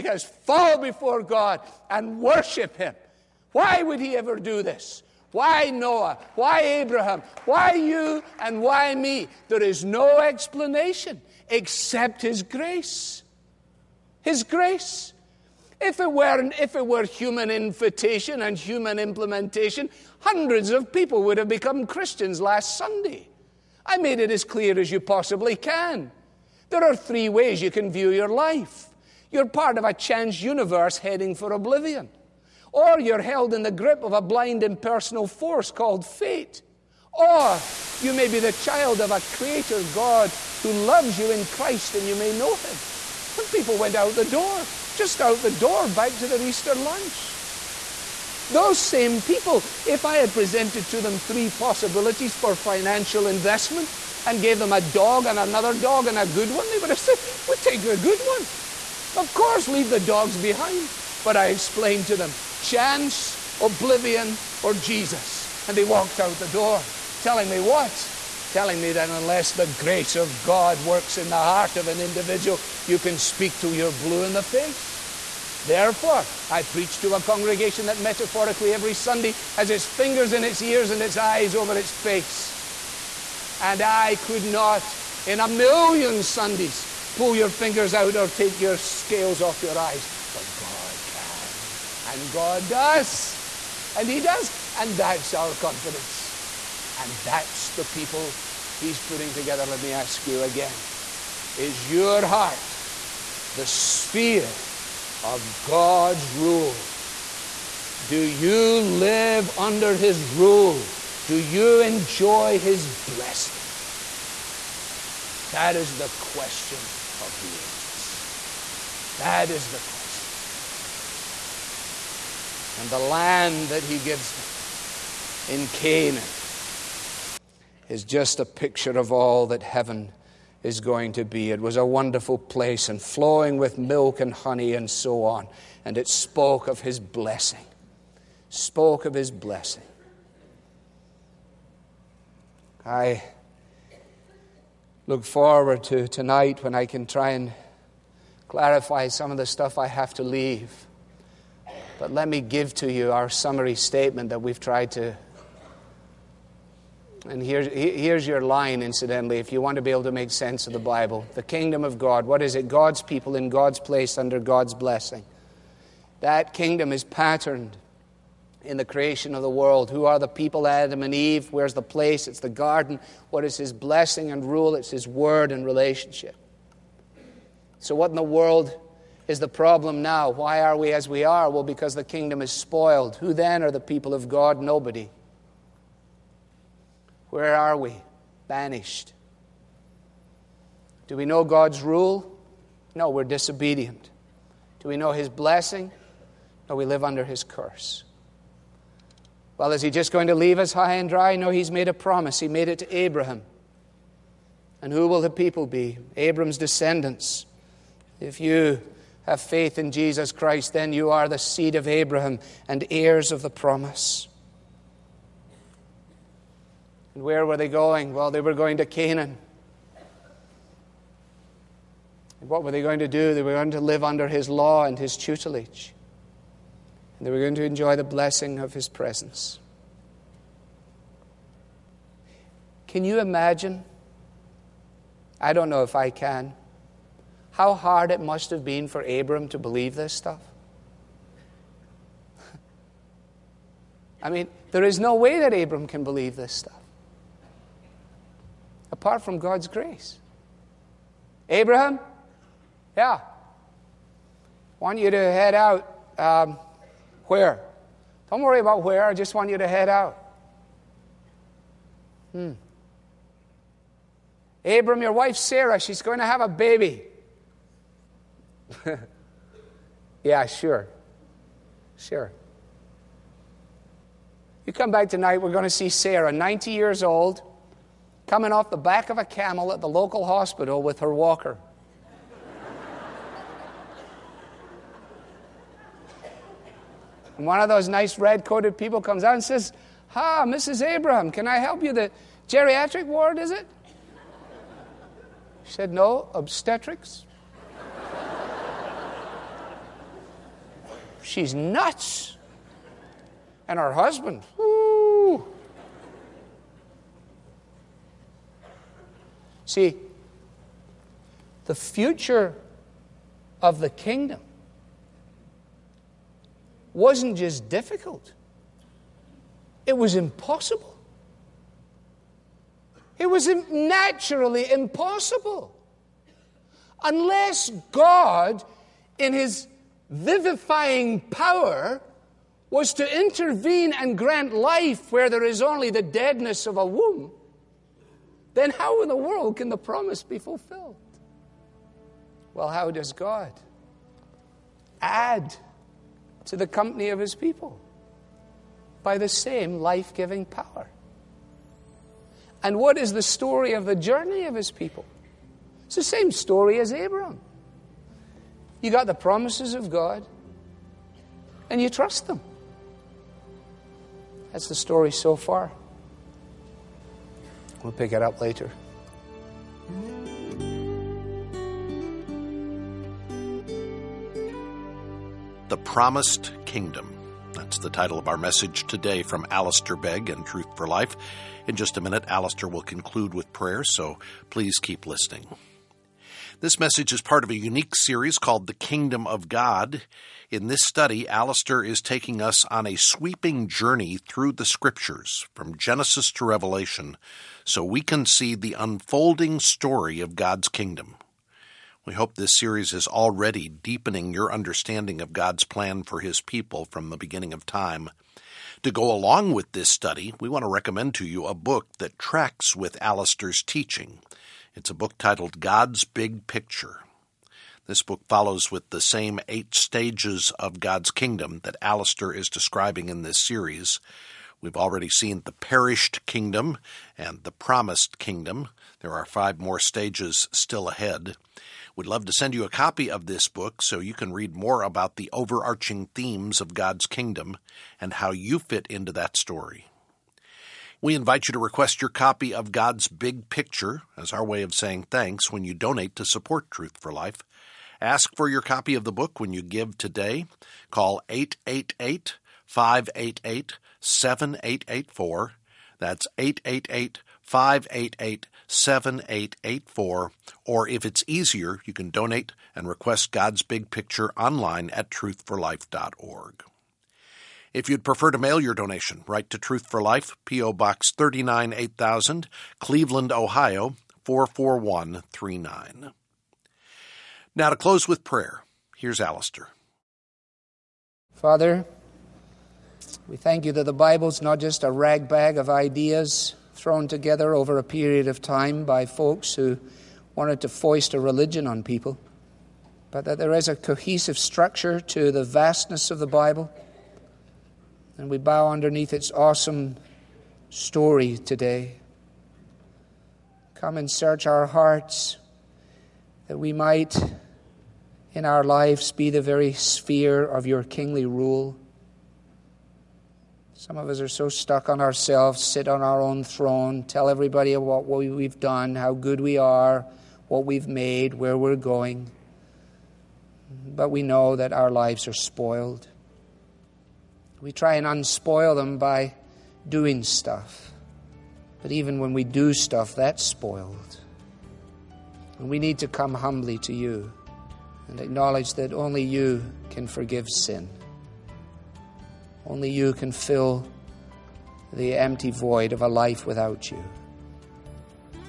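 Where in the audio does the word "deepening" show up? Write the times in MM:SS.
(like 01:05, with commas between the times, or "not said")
06:43.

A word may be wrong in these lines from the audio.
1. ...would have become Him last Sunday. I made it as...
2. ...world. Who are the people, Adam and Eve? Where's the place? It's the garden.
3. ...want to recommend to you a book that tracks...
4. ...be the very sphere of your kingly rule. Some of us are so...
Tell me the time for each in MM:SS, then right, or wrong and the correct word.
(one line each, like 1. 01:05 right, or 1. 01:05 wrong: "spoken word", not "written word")
1. 00:21 wrong: "Christians", not "Him"
2. 02:49 right
3. 06:50 right
4. 08:29 right.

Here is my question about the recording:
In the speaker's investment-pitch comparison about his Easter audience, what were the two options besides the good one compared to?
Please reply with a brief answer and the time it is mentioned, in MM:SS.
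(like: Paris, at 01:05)
dogs, at 00:54.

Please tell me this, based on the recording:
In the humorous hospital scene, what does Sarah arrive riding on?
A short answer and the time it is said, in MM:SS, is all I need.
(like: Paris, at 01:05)
a camel, at 04:39.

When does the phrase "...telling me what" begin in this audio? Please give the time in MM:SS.
01:07.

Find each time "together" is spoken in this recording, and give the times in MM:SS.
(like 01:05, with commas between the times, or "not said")
01:39, 08:07.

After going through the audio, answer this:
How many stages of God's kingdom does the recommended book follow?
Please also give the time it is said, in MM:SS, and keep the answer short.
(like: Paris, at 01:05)
8, at 06:59.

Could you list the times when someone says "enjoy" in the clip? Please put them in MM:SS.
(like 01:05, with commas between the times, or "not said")
01:51, 03:47.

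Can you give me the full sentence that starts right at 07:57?
Now to close with prayer, here's Alistair.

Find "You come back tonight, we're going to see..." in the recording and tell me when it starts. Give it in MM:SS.
04:34.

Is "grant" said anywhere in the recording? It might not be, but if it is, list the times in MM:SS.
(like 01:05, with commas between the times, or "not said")
05:34.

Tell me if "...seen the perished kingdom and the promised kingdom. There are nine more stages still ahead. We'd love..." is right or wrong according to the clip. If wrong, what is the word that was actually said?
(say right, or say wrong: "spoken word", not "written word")
wrong: "five", not "nine".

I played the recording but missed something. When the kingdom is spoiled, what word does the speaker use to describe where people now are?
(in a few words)
Banished.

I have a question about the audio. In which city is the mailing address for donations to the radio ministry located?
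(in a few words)
Cleveland.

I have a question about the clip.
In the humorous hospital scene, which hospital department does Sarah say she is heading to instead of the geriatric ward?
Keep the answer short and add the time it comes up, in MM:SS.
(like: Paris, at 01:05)
obstetrics, at 04:56.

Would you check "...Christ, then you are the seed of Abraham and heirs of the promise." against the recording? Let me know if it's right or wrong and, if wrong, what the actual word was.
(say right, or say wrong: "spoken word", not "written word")
right.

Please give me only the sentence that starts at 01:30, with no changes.
But God can, and God does, and He does.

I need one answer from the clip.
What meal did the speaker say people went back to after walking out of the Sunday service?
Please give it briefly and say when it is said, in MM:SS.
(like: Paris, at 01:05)
Easter lunch, at 00:46.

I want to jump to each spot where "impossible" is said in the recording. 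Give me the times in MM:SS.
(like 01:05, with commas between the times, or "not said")
05:20, 05:24.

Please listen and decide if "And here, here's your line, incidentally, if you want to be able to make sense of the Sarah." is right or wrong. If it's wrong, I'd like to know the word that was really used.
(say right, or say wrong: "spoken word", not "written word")
wrong: "Bible", not "Sarah".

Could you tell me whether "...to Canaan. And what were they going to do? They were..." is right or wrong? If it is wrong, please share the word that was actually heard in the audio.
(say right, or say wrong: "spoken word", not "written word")
right.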